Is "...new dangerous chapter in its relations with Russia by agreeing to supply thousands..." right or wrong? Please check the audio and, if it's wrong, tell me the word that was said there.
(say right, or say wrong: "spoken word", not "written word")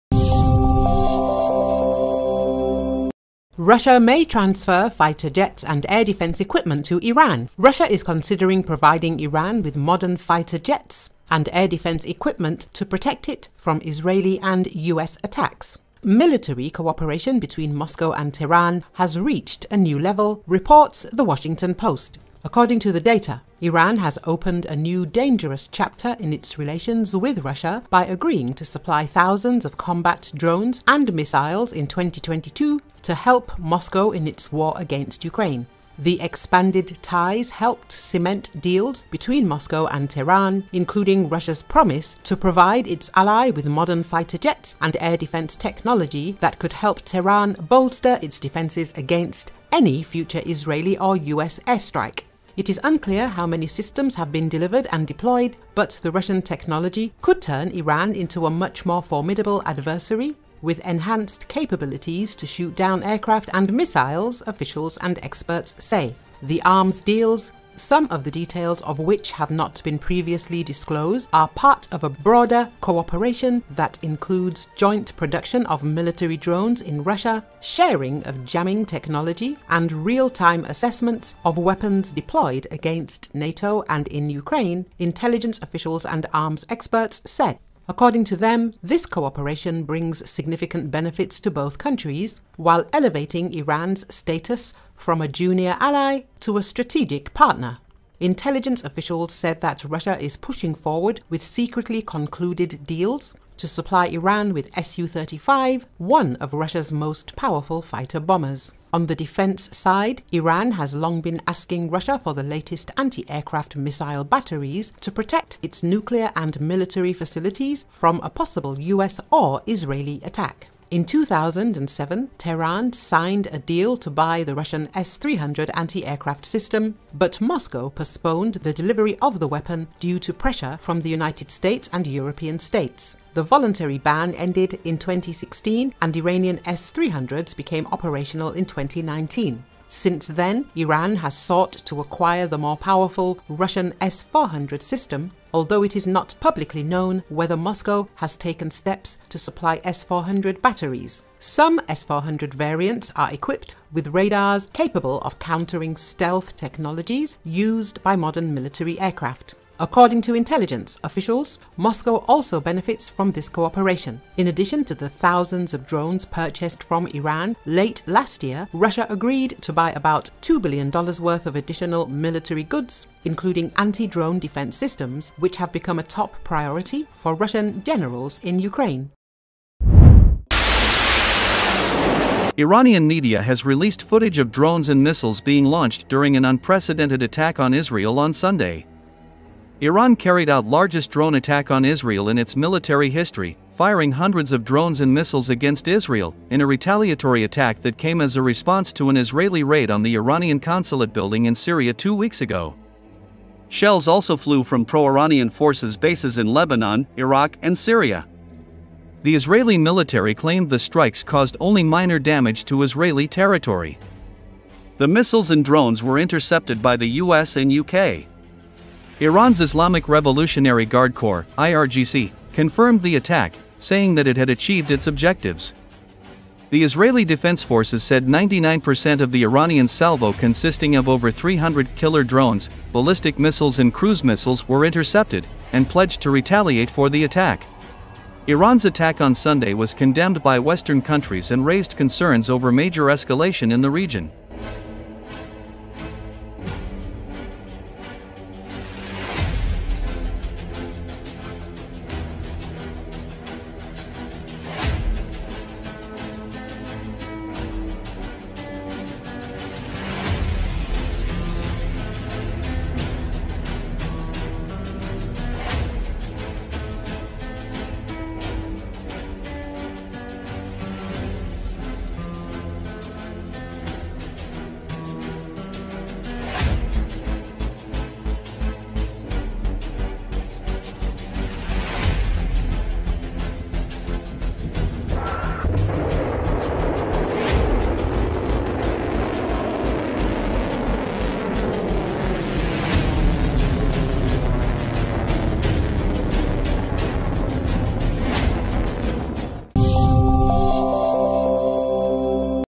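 right.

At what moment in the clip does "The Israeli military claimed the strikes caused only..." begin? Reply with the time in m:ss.
3:29.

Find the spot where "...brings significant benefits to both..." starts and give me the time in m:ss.
1:29.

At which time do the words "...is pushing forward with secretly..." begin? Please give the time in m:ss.
1:40.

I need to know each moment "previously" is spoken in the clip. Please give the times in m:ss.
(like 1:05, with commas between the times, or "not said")
1:09.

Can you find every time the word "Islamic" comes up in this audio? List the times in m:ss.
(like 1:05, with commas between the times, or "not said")
3:39.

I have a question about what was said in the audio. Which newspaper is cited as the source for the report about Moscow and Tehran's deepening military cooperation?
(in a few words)
The Washington Post.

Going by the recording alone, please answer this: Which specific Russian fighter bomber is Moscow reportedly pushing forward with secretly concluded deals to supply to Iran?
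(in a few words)
Su-35.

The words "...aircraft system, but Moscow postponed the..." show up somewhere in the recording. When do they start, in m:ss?
2:06.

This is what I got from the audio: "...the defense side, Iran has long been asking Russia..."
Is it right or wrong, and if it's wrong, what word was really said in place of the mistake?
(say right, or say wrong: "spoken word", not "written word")
right.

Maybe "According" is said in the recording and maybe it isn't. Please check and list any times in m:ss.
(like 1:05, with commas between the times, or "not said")
0:22, 1:27, 2:39.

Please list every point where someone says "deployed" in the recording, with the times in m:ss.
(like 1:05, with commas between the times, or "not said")
0:55, 1:22.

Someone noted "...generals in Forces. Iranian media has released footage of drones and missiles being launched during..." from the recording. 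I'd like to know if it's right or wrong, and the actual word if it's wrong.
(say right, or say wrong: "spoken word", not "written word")
wrong: "Ukraine", not "Forces".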